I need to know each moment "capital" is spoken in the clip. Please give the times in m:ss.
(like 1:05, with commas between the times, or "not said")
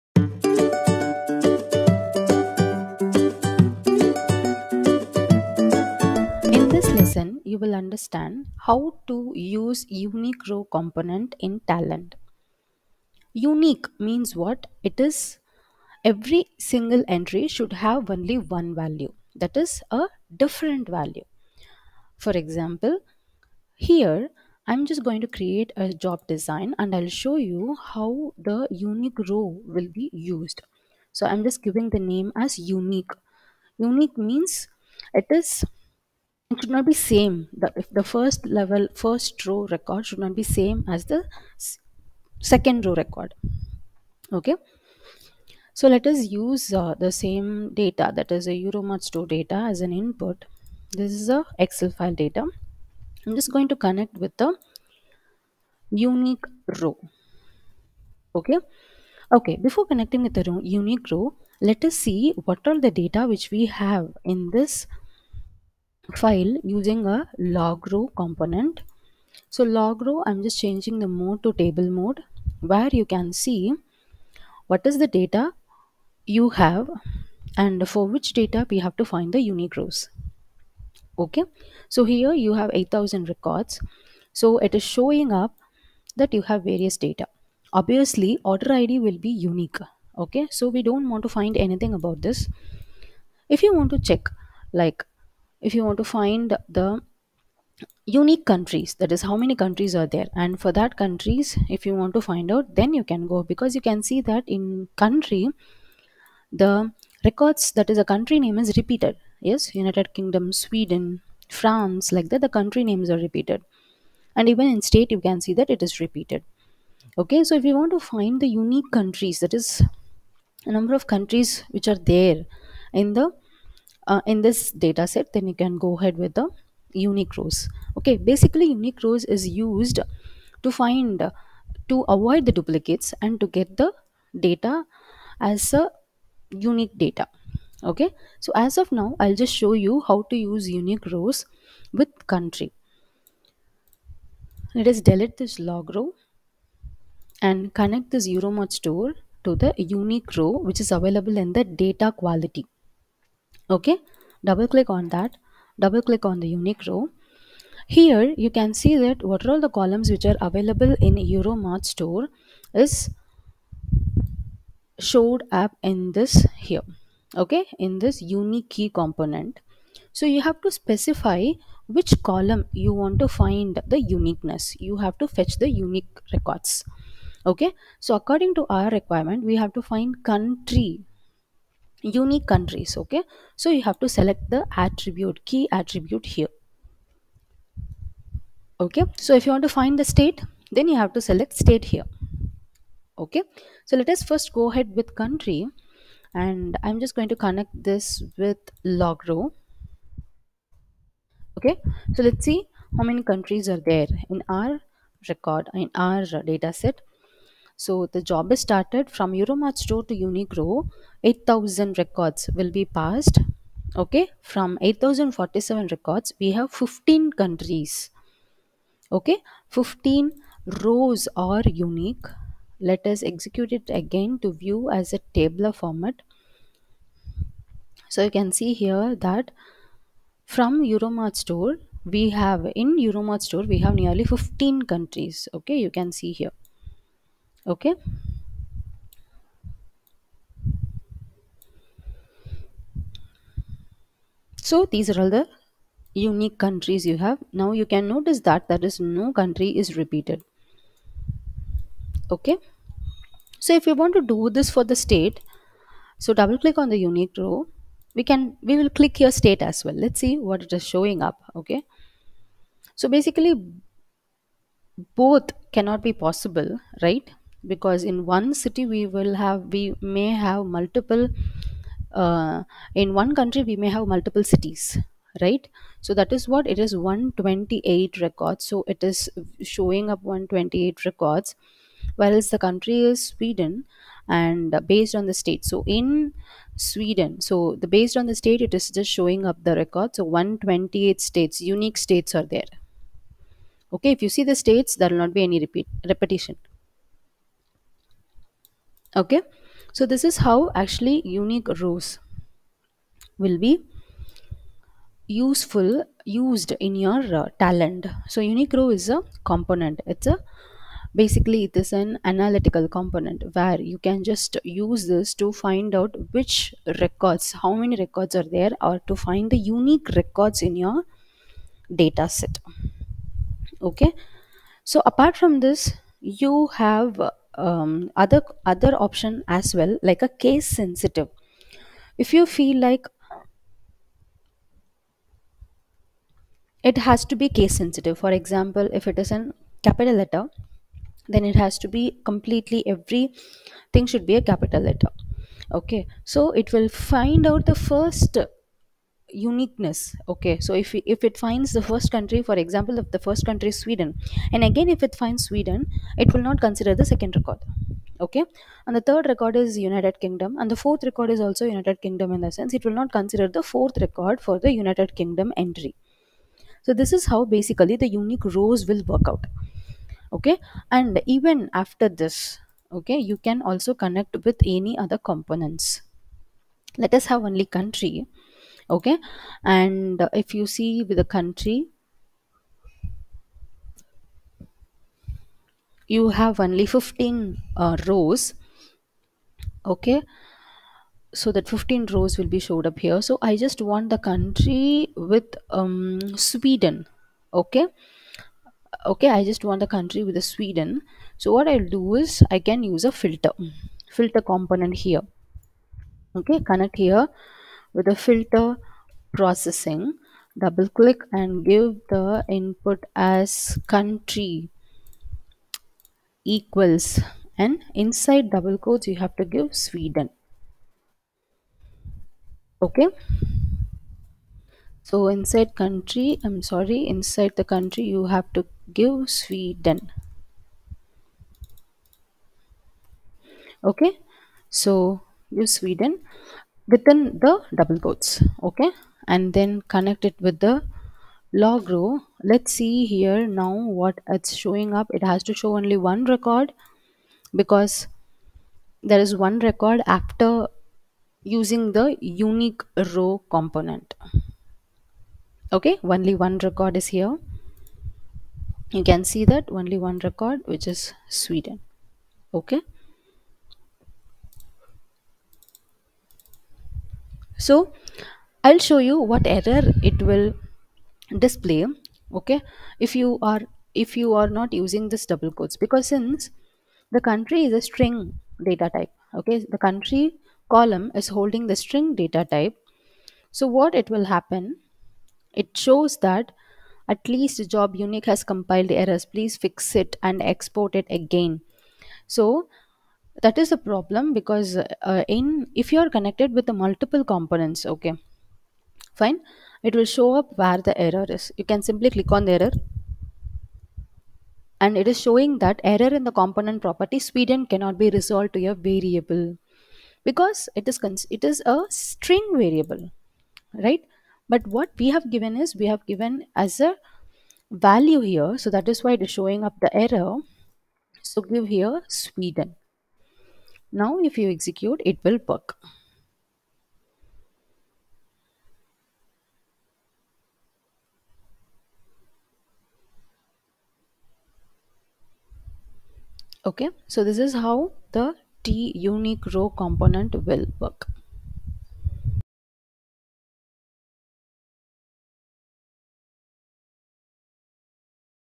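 5:39, 5:44.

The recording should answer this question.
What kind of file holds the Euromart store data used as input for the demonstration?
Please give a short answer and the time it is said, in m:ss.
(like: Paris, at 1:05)
Excel file, at 0:51.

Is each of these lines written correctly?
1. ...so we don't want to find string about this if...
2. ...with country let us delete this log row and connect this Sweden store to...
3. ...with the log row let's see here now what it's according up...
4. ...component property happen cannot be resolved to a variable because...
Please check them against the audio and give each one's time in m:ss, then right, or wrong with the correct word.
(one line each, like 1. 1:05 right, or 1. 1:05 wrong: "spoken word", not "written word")
1. 1:30 wrong: "anything", not "string"
2. 2:21 wrong: "Euromart", not "Sweden"
3. 7:20 wrong: "showing", not "according"
4. 8:26 wrong: "sweden", not "happen".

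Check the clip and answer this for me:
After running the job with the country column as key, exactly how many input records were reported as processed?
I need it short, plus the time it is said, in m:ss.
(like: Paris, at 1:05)
8047, at 3:34.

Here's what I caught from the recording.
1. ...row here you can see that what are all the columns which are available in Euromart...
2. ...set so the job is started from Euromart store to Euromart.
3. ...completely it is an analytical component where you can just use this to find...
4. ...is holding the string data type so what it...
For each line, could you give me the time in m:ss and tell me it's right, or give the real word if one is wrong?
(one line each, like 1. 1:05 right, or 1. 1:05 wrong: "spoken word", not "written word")
1. 2:36 right
2. 3:26 wrong: "UniqRow", not "Euromart"
3. 5:11 wrong: "basically", not "completely"
4. 8:01 right.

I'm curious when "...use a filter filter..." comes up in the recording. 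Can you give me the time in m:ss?
6:42.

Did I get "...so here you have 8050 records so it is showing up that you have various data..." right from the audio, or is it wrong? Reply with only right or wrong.
wrong.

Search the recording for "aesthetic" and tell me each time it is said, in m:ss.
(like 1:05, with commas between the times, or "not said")
not said.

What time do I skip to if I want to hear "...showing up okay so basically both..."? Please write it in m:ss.
4:20.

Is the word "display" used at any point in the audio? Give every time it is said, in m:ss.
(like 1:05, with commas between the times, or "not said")
7:51.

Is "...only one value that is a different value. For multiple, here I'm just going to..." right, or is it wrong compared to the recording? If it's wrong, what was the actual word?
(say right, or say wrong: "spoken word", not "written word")
wrong: "example", not "multiple".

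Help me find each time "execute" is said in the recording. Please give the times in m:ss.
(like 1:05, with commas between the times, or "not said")
3:43, 8:44.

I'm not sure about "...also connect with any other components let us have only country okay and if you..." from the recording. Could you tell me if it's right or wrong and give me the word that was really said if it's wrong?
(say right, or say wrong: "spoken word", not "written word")
right.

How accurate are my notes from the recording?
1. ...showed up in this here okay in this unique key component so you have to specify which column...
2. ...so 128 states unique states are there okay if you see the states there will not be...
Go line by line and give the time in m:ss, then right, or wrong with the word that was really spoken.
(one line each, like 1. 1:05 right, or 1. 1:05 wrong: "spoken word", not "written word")
1. 2:44 right
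2. 4:50 right.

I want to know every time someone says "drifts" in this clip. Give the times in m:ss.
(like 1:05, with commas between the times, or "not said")
not said.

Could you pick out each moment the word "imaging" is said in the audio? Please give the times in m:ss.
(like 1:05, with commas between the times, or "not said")
not said.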